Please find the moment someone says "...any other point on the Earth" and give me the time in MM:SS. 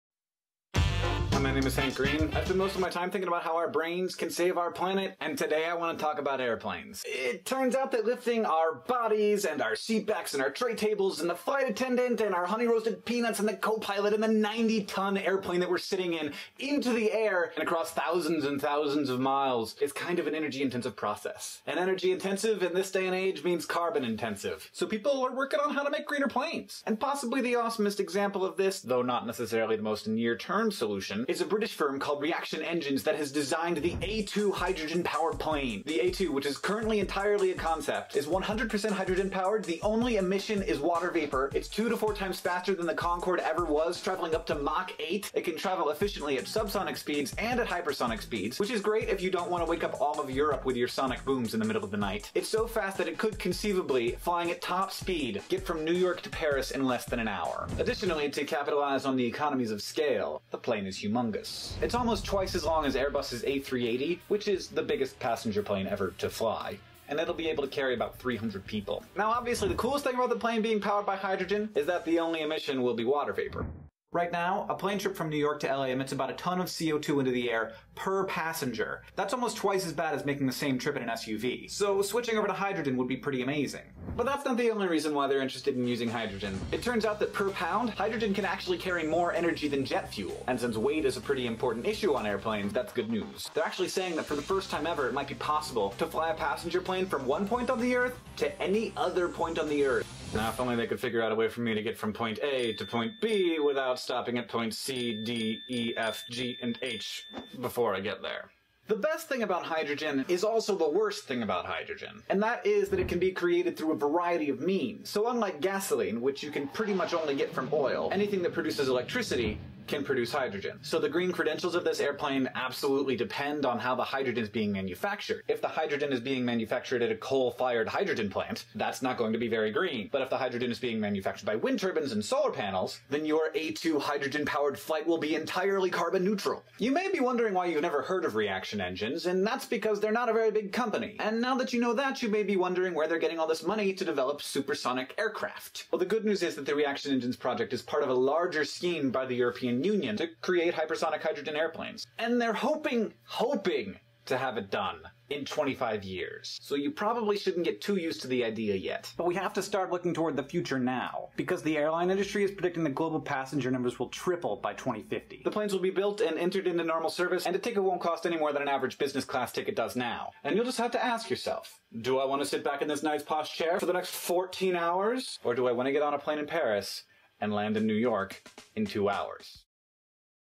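01:38.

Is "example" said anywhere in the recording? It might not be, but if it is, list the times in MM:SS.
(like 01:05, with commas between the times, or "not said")
00:27.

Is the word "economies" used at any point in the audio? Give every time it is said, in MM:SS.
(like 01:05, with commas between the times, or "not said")
00:59.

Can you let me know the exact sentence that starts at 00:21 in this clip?
And energy intensive in this day and age means carbon intensive.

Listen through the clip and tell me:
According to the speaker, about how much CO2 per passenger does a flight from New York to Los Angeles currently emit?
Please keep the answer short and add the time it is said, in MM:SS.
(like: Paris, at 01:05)
a ton, at 01:16.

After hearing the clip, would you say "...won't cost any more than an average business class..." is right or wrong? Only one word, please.
right.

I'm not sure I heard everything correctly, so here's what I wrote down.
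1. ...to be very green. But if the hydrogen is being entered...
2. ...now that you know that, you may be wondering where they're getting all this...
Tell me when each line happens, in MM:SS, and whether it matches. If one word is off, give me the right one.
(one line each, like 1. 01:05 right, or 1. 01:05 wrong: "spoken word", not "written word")
1. 02:09 wrong: "manufactured", not "entered"
2. 02:21 right.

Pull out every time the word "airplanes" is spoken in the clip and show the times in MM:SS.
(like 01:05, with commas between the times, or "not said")
00:06, 00:15, 01:32, 02:01, 02:31.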